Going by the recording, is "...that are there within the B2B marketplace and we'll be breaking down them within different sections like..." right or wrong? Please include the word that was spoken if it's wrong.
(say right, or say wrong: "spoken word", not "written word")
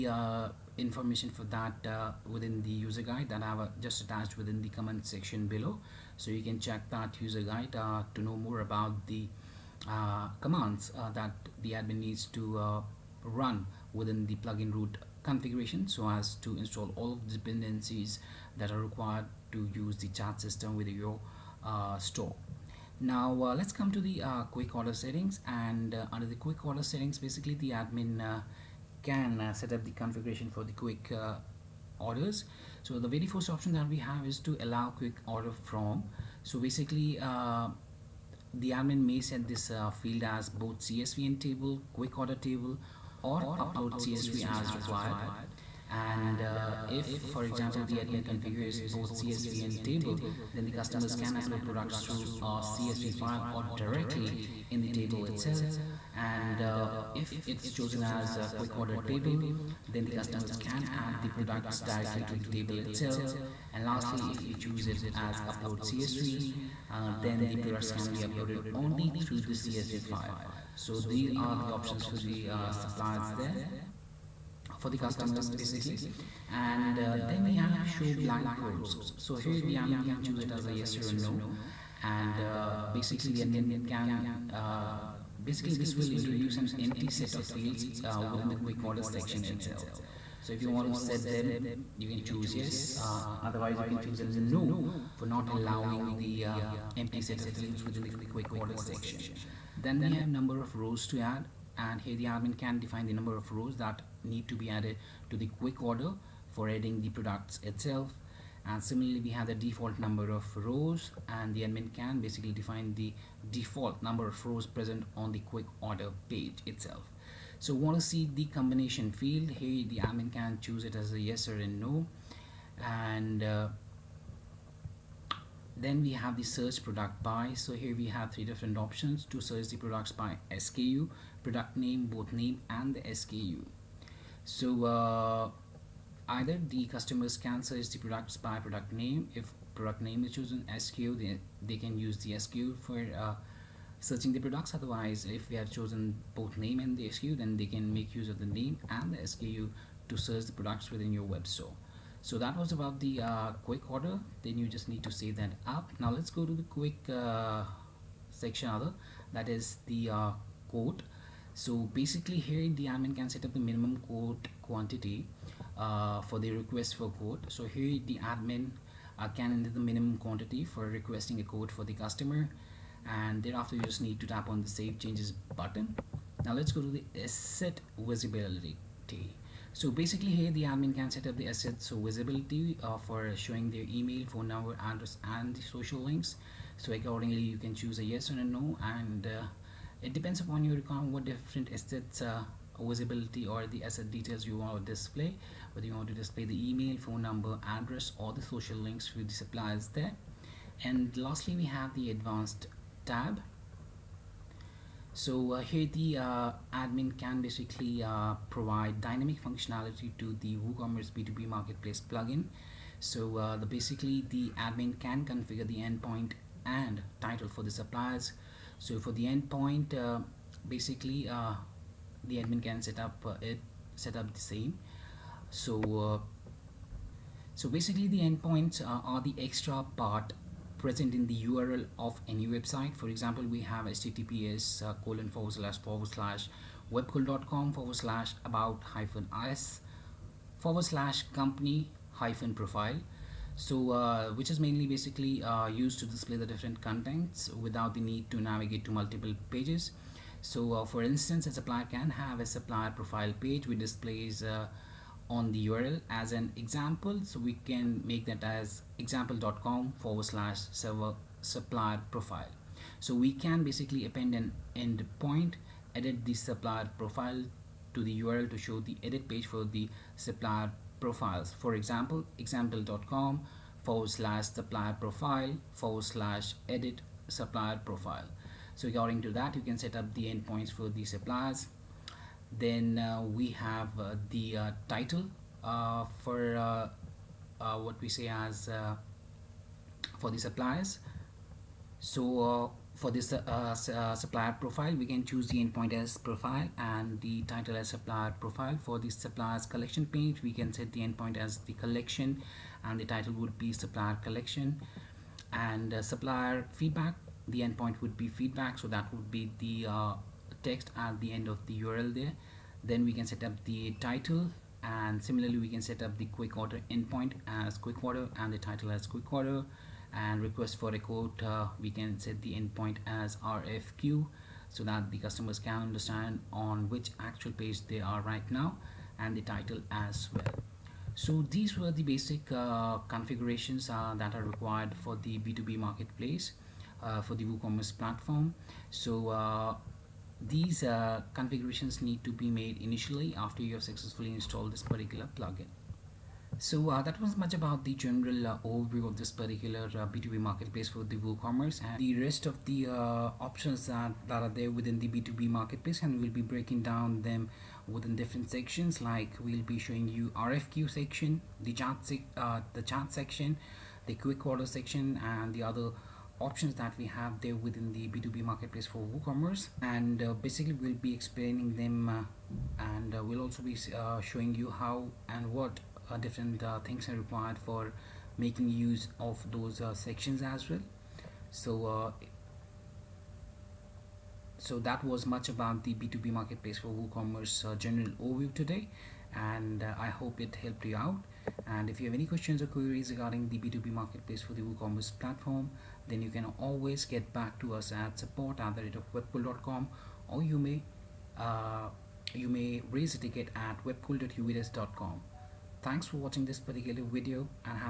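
right.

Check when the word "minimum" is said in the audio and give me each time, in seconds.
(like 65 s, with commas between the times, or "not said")
163 s, 169 s.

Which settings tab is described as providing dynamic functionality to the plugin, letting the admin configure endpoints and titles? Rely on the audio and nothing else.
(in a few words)
Advanced tab.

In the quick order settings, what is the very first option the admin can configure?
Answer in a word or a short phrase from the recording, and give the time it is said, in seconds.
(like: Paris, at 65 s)
Allow quick order from, at 34 s.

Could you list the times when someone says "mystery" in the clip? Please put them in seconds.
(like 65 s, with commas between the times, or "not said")
not said.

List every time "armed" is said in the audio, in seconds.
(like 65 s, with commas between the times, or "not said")
not said.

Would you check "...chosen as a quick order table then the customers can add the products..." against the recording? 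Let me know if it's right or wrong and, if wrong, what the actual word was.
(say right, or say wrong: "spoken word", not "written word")
right.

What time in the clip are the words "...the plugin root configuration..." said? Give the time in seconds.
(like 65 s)
14 s.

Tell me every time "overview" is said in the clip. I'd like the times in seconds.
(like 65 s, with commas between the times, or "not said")
348 s, 388 s.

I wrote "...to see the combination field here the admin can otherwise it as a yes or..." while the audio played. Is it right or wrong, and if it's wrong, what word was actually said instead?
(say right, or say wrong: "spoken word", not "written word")
wrong: "choose", not "otherwise".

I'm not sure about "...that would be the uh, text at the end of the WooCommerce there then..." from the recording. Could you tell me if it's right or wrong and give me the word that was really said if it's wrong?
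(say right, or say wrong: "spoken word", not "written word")
wrong: "URL", not "WooCommerce".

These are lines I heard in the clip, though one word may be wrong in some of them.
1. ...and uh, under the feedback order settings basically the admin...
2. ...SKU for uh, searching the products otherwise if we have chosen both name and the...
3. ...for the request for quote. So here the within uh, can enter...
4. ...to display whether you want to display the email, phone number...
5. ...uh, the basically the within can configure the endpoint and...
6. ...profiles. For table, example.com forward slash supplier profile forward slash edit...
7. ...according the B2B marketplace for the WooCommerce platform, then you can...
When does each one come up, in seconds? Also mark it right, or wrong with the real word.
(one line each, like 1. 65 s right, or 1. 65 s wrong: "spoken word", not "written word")
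1. 25 s wrong: "quick", not "feedback"
2. 142 s right
3. 166 s wrong: "admin", not "within"
4. 194 s right
5. 213 s wrong: "admin", not "within"
6. 270 s wrong: "example", not "table"
7. 393 s wrong: "regarding", not "according".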